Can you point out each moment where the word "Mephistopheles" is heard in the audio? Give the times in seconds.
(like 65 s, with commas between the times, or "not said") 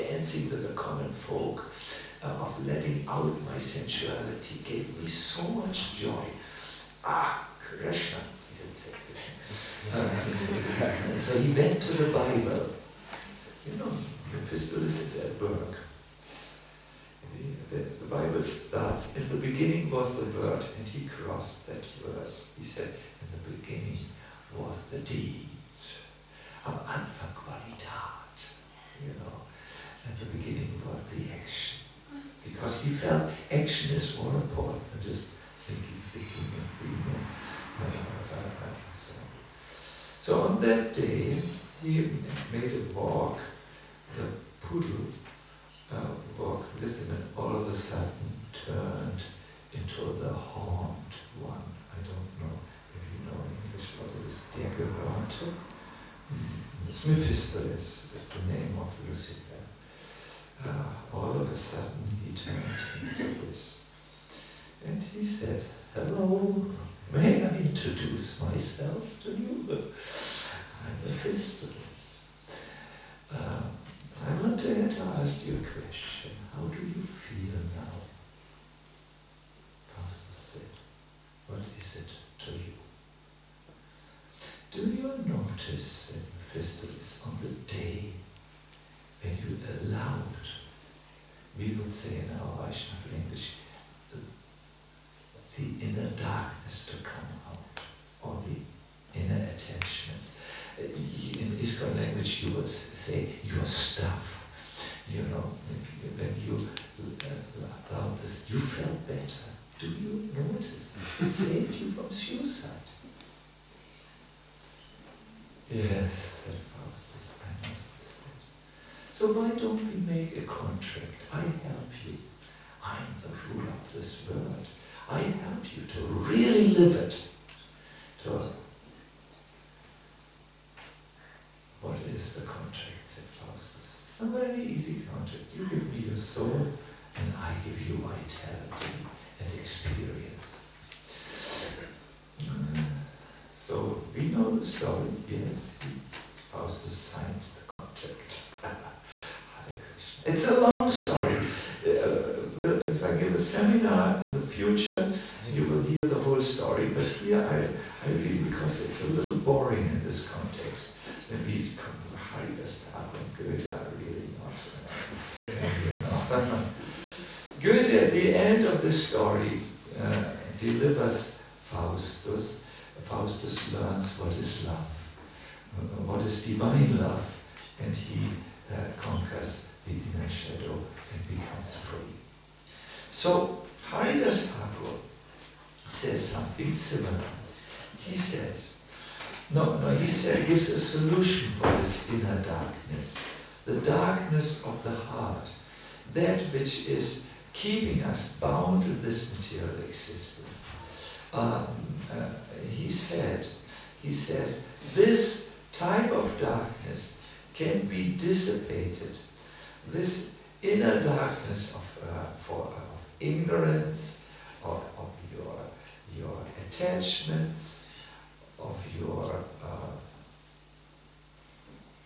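57 s, 71 s.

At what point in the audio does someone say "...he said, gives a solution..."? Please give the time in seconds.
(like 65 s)
189 s.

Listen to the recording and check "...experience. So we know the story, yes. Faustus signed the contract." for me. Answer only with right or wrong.
right.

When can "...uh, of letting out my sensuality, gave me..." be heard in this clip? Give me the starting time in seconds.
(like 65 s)
2 s.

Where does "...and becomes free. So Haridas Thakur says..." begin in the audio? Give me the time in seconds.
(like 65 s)
181 s.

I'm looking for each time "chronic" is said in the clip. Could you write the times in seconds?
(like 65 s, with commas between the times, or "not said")
not said.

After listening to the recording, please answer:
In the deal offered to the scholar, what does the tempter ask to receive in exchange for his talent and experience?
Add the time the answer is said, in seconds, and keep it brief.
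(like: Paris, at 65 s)
your soul, at 135 s.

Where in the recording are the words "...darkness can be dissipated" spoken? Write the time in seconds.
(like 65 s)
206 s.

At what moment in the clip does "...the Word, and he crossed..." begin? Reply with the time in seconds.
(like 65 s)
20 s.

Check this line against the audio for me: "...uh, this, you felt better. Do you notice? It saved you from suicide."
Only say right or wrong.
right.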